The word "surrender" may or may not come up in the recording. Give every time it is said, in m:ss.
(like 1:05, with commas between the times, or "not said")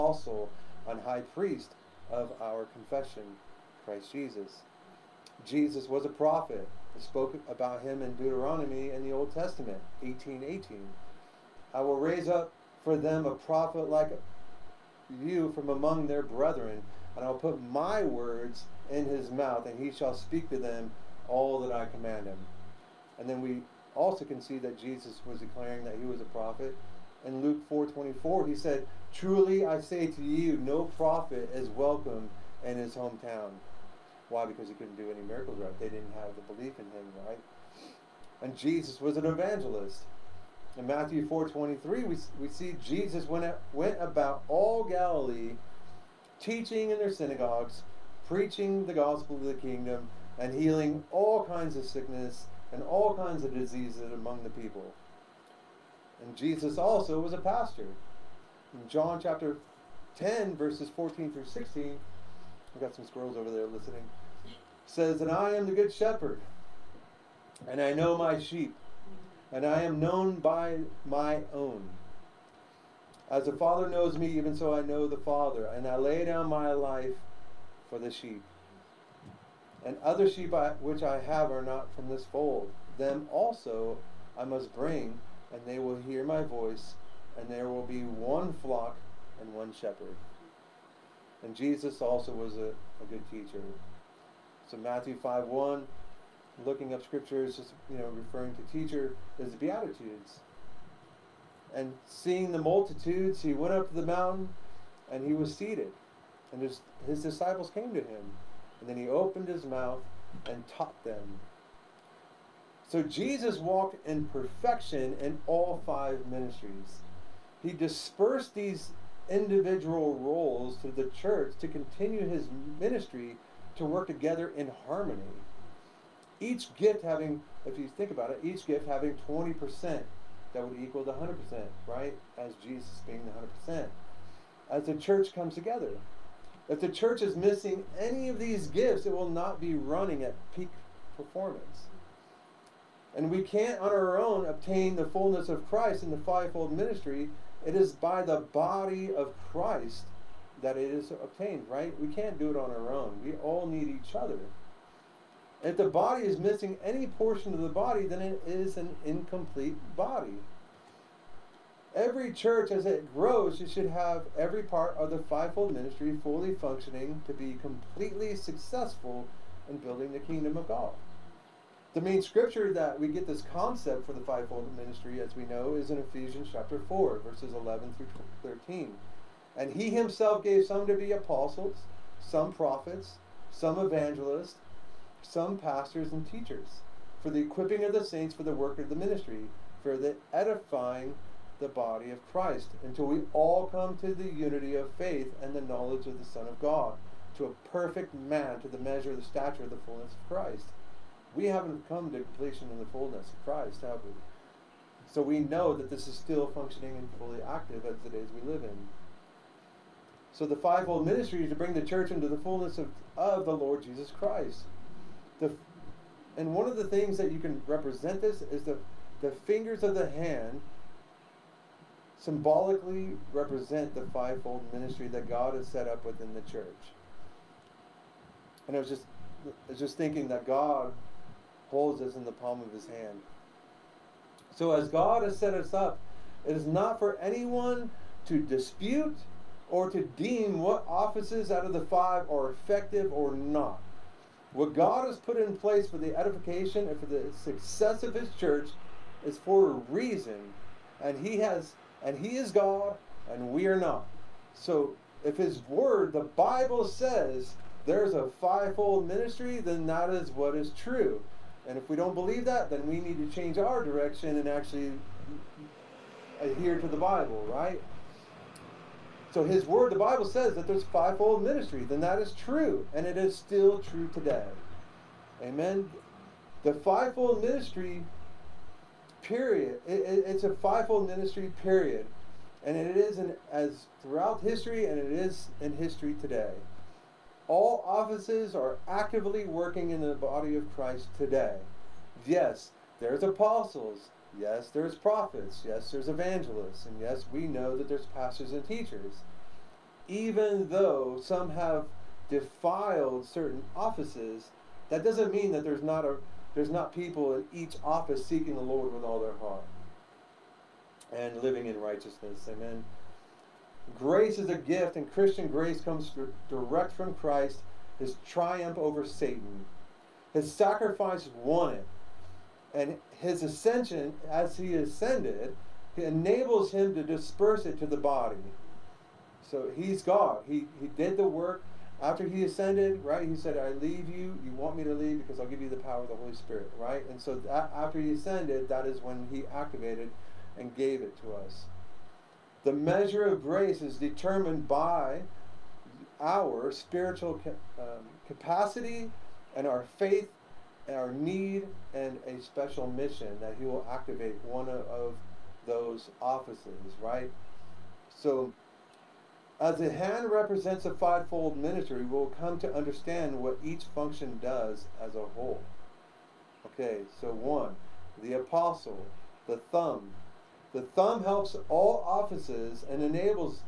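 not said.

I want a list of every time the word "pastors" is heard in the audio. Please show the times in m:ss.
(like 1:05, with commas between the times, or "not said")
0:57, 3:05, 4:58.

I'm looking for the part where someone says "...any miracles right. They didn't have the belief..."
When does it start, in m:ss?
0:35.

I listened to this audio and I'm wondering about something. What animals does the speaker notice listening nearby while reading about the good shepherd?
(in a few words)
Squirrels.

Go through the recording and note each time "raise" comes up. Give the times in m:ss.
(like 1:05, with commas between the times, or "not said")
0:11.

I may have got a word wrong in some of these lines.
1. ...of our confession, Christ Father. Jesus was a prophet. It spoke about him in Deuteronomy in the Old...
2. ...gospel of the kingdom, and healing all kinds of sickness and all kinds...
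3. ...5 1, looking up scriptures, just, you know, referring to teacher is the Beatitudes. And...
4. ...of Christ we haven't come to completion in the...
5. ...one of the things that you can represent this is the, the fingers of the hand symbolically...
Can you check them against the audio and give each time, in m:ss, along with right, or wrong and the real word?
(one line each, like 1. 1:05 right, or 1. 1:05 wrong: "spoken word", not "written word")
1. 0:02 wrong: "Jesus", not "Father"
2. 0:48 right
3. 1:35 right
4. 3:20 right
5. 3:36 right.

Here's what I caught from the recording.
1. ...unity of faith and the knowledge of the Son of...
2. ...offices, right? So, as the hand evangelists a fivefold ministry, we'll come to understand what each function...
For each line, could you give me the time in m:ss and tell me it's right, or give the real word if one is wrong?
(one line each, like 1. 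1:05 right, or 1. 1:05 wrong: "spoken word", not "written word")
1. 3:14 right
2. 5:56 wrong: "represents", not "evangelists".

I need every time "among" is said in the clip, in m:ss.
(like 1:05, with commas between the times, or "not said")
0:15, 0:54.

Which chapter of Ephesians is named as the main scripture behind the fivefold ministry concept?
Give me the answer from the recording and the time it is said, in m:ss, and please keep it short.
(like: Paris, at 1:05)
Chapter 4, at 2:55.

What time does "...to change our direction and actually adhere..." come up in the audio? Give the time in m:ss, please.
4:23.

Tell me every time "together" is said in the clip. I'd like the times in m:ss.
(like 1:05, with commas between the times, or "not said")
2:04, 2:15.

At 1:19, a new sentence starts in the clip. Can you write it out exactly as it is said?
And other sheep I, which I have are not from this fold.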